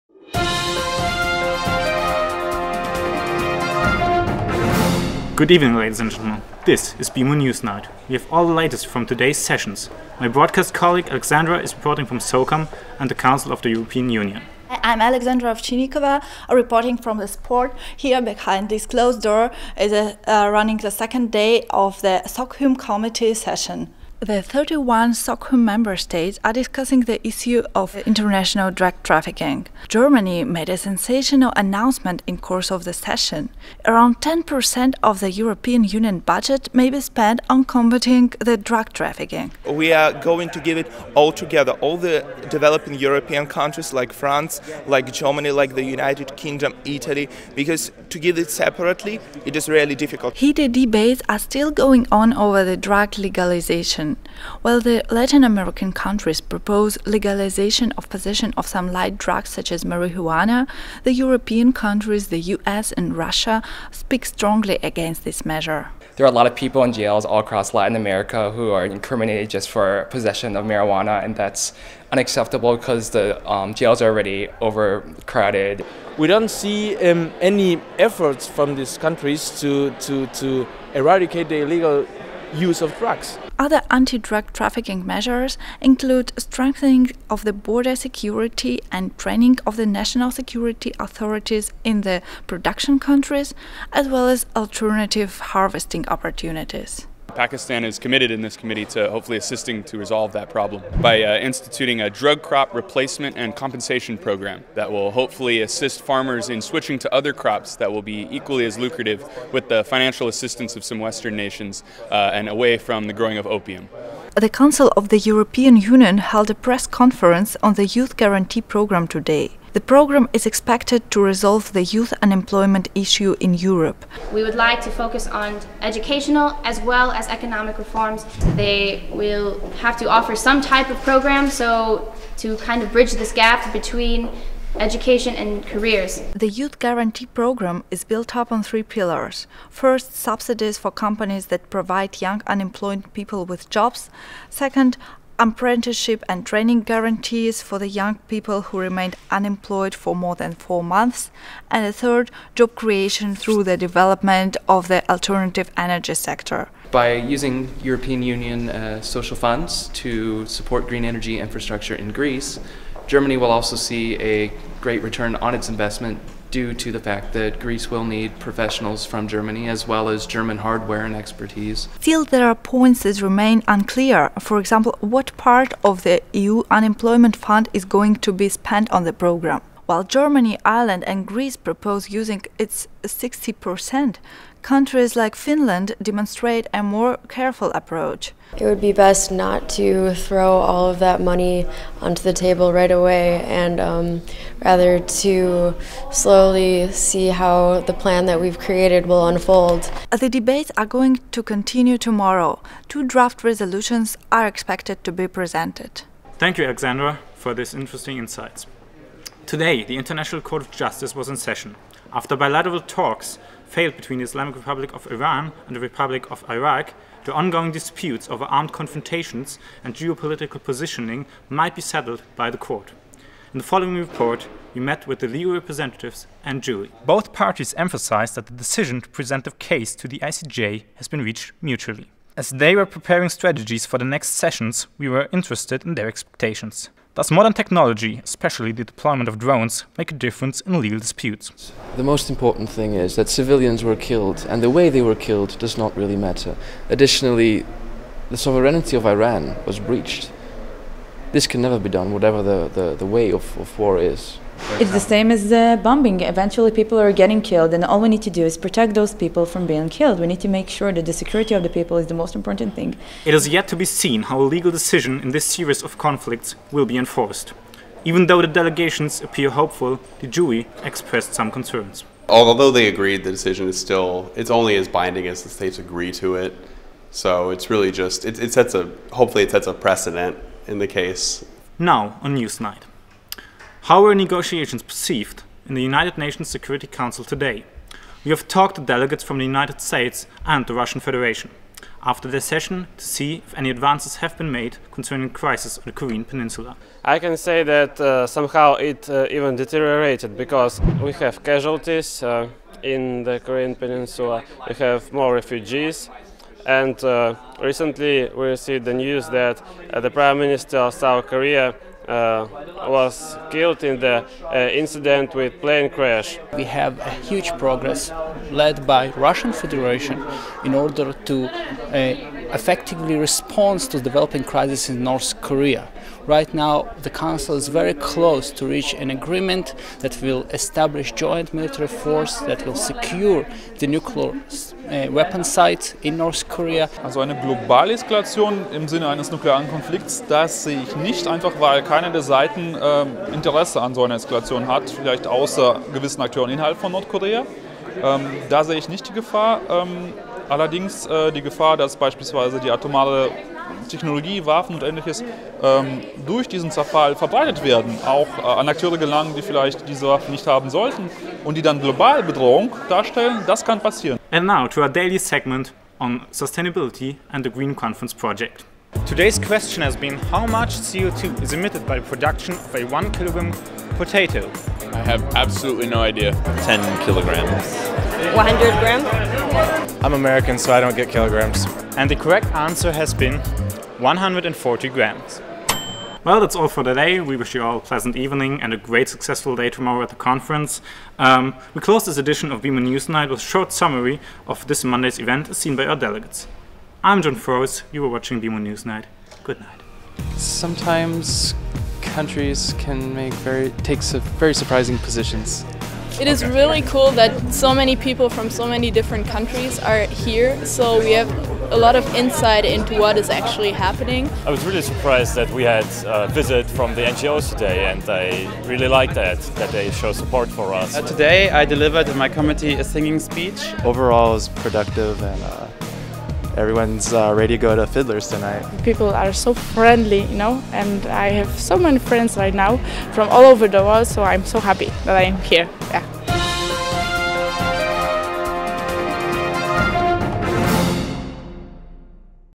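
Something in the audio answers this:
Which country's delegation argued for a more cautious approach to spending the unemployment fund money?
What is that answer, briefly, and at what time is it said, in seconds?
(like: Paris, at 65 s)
Finland, at 185 s.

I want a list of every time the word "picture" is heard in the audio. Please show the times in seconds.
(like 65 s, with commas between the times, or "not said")
not said.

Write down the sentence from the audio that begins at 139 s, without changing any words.
First, subsidies for companies that provide young unemployed people with jobs.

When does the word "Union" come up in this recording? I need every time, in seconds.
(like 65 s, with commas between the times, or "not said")
14 s, 35 s, 115 s, 158 s.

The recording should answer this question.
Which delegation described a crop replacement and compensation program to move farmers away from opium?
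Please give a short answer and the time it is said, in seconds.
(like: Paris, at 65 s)
Pakistan, at 97 s.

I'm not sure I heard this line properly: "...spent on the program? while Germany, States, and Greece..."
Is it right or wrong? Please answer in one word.
wrong.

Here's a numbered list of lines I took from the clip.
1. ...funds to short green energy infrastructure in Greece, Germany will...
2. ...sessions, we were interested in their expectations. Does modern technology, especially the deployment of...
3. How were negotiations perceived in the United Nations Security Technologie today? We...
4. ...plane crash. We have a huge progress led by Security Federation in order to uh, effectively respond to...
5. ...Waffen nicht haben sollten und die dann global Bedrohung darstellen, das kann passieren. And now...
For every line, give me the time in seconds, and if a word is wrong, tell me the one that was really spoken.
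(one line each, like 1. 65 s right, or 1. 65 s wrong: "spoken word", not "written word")
1. 159 s wrong: "support", not "short"
2. 234 s right
3. 283 s wrong: "Council", not "Technologie"
4. 315 s wrong: "Russian", not "Security"
5. 360 s right.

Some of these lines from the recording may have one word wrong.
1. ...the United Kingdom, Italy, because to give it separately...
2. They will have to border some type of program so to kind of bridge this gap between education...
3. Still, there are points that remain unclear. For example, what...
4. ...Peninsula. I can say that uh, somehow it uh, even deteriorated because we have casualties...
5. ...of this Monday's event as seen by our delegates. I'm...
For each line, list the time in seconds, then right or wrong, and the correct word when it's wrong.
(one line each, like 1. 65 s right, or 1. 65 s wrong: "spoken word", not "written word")
1. 45 s right
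2. 128 s wrong: "offer", not "border"
3. 172 s right
4. 296 s right
5. 394 s right.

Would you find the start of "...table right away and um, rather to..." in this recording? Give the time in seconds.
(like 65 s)
192 s.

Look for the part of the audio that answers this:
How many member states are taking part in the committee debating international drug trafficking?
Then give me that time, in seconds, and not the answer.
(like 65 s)
24 s.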